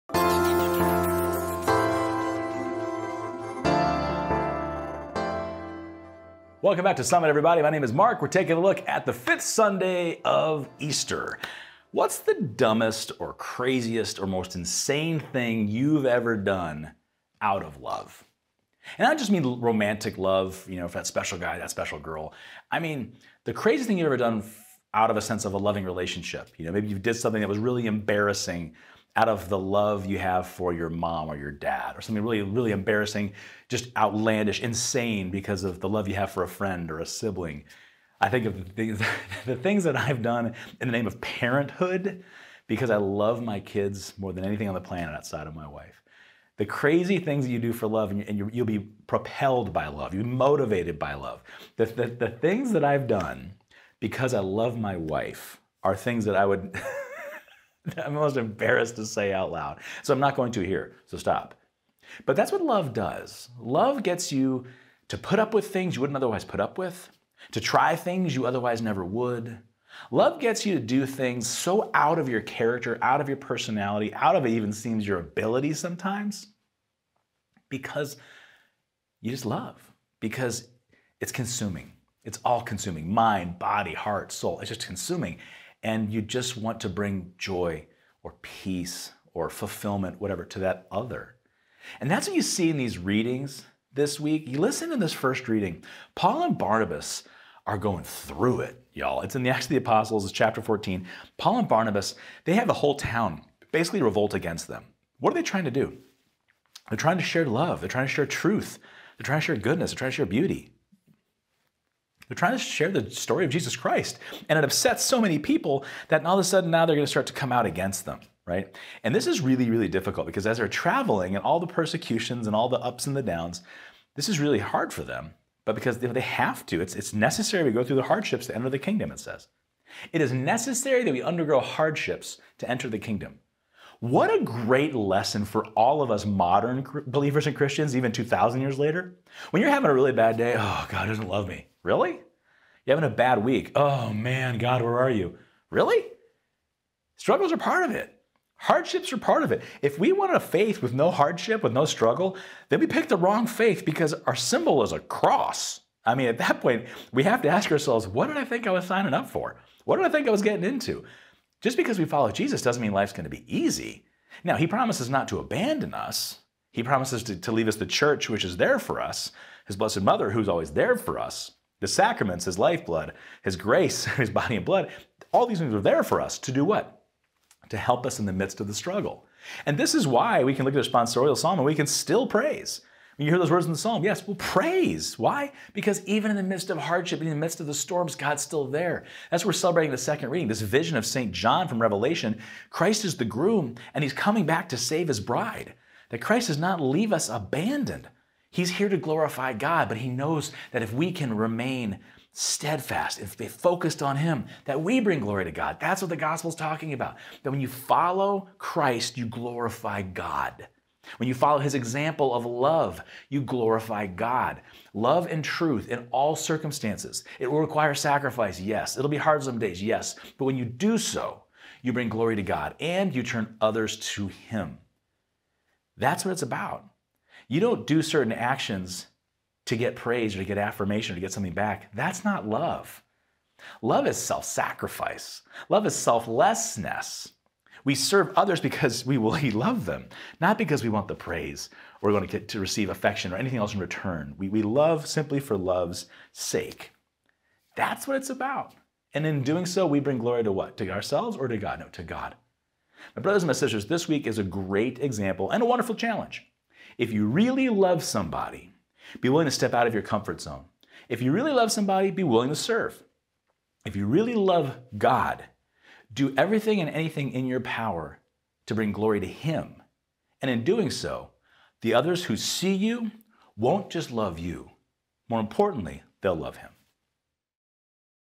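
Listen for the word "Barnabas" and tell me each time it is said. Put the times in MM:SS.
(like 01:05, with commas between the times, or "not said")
01:36, 01:41.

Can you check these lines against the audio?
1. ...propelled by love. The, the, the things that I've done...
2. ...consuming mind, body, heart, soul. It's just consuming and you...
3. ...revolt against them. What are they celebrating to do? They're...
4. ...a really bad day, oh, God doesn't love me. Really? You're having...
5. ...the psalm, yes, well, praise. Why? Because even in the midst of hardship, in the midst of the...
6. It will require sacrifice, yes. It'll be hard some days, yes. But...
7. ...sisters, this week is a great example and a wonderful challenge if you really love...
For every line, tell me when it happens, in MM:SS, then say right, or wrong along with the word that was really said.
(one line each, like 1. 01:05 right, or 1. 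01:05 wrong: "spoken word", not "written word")
1. 00:50 wrong: "motivated", not "propelled"
2. 01:22 right
3. 01:44 wrong: "trying", not "celebrating"
4. 02:19 right
5. 03:03 right
6. 03:37 right
7. 04:13 right.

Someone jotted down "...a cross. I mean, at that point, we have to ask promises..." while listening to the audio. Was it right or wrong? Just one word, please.
wrong.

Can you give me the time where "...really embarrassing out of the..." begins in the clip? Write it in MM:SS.
00:27.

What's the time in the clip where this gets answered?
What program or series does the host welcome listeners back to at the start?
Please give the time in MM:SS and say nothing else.
00:07.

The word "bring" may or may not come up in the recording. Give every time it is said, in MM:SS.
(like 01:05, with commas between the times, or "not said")
01:26, 03:24, 03:41, 04:09, 04:28.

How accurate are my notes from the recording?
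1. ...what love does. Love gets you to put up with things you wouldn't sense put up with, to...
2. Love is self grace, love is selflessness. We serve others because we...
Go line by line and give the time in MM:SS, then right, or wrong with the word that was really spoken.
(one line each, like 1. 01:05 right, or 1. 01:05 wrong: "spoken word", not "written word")
1. 01:02 wrong: "otherwise", not "sense"
2. 03:53 wrong: "sacrifice", not "grace".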